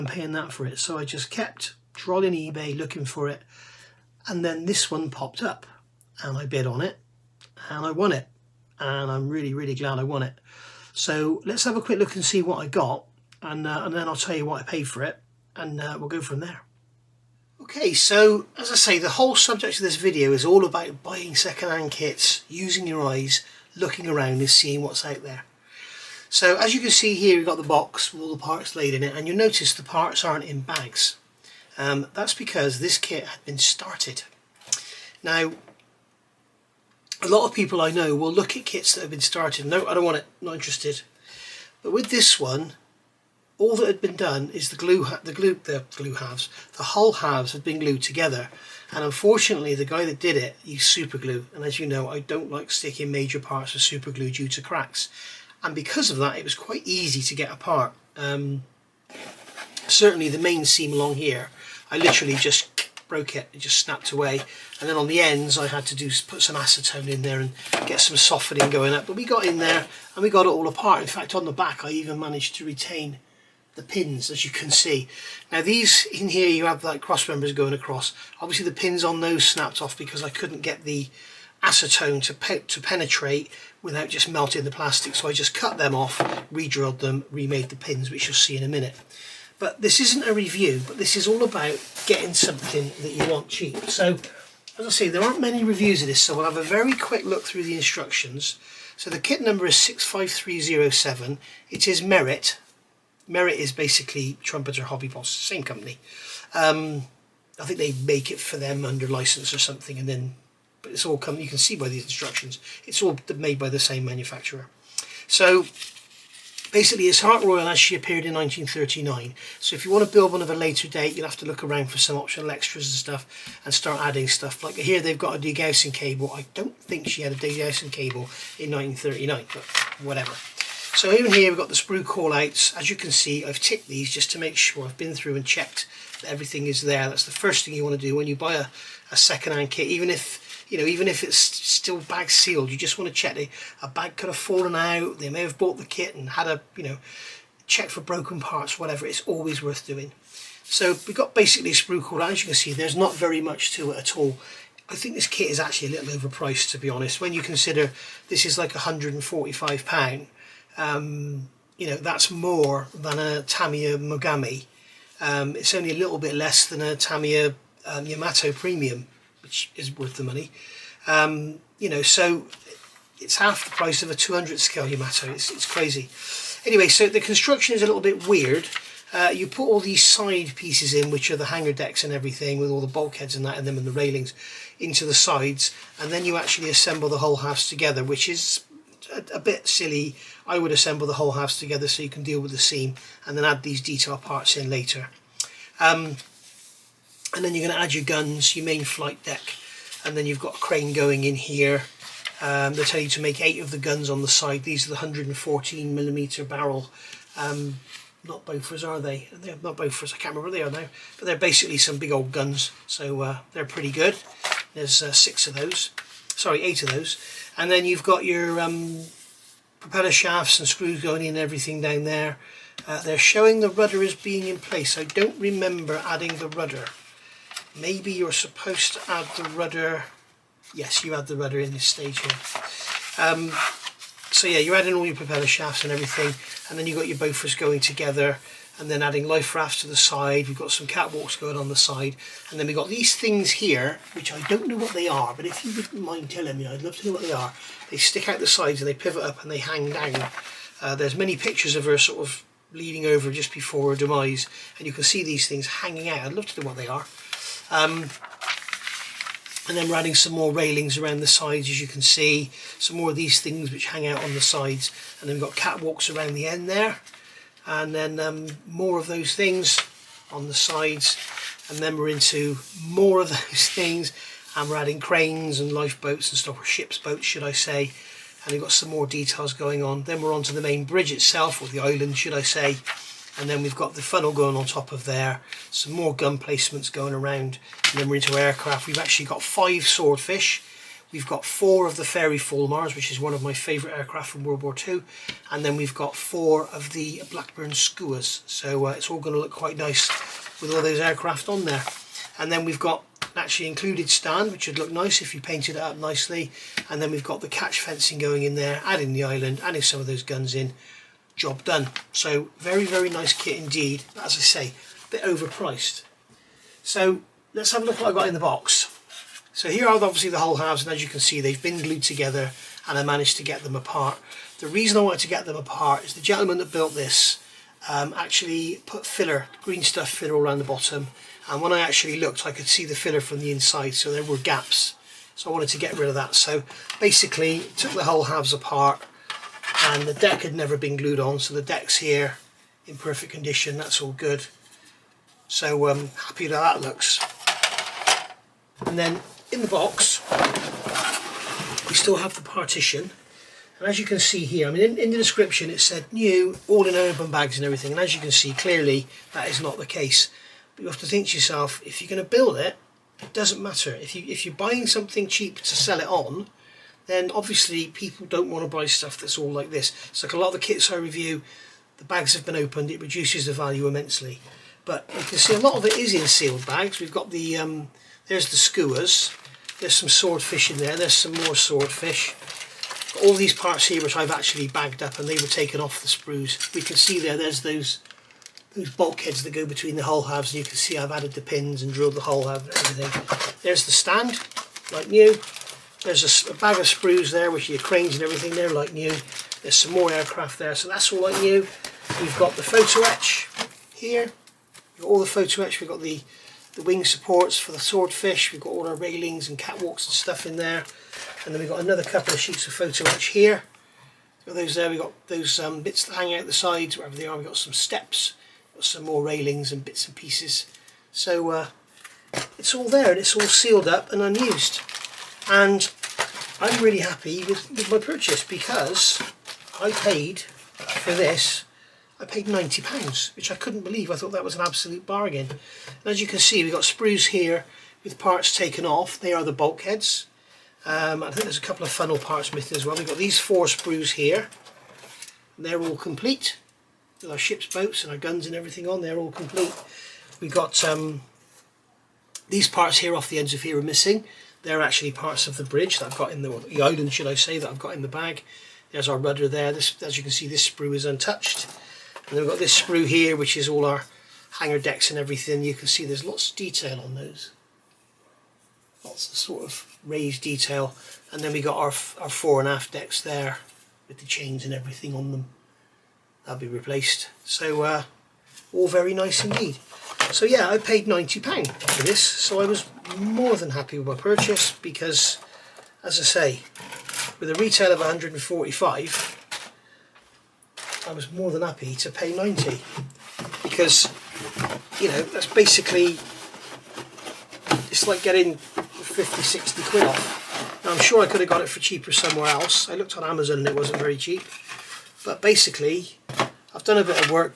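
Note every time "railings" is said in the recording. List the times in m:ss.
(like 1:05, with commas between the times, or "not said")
3:03, 4:20, 6:48, 6:59.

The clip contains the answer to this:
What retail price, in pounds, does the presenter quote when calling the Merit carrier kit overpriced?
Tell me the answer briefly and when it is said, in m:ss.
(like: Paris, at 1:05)
£145, at 2:38.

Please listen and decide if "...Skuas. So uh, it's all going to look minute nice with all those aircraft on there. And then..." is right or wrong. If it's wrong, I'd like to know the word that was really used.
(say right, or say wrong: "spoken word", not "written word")
wrong: "quite", not "minute".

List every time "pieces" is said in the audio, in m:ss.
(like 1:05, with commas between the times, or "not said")
3:00, 7:00.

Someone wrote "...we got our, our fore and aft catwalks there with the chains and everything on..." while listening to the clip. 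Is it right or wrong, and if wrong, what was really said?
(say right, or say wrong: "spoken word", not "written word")
wrong: "decks", not "catwalks".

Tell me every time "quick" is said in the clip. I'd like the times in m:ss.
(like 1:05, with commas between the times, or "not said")
0:11, 1:36.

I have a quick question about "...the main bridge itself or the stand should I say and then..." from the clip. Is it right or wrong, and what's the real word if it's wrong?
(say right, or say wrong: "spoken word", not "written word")
wrong: "island", not "stand".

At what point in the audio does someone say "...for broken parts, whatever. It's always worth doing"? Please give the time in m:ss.
2:27.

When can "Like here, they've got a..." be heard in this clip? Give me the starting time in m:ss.
2:04.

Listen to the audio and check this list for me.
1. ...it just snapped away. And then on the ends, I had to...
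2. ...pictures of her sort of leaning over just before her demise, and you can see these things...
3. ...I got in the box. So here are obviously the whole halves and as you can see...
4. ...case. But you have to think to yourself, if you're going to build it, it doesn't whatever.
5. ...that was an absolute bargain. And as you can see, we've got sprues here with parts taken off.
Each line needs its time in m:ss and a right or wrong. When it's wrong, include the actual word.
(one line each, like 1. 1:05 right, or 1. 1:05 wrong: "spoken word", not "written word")
1. 1:03 right
2. 4:11 right
3. 5:18 right
4. 5:59 wrong: "matter", not "whatever"
5. 7:14 right.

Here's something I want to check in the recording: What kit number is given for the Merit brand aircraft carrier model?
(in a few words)
65307.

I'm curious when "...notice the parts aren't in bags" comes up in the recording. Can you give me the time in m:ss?
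0:29.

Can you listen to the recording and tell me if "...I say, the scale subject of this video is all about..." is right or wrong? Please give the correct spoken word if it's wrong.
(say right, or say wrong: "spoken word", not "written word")
wrong: "whole", not "scale".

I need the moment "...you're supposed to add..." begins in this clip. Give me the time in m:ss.
3:48.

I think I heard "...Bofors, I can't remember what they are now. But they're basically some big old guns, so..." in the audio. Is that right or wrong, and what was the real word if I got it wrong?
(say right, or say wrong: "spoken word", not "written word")
right.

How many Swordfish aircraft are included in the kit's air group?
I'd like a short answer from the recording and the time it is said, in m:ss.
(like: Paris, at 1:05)
5, at 4:49.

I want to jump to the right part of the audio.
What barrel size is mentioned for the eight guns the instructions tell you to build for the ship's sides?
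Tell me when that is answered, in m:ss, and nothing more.
3:24.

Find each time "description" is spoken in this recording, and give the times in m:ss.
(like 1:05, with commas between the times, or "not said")
5:55.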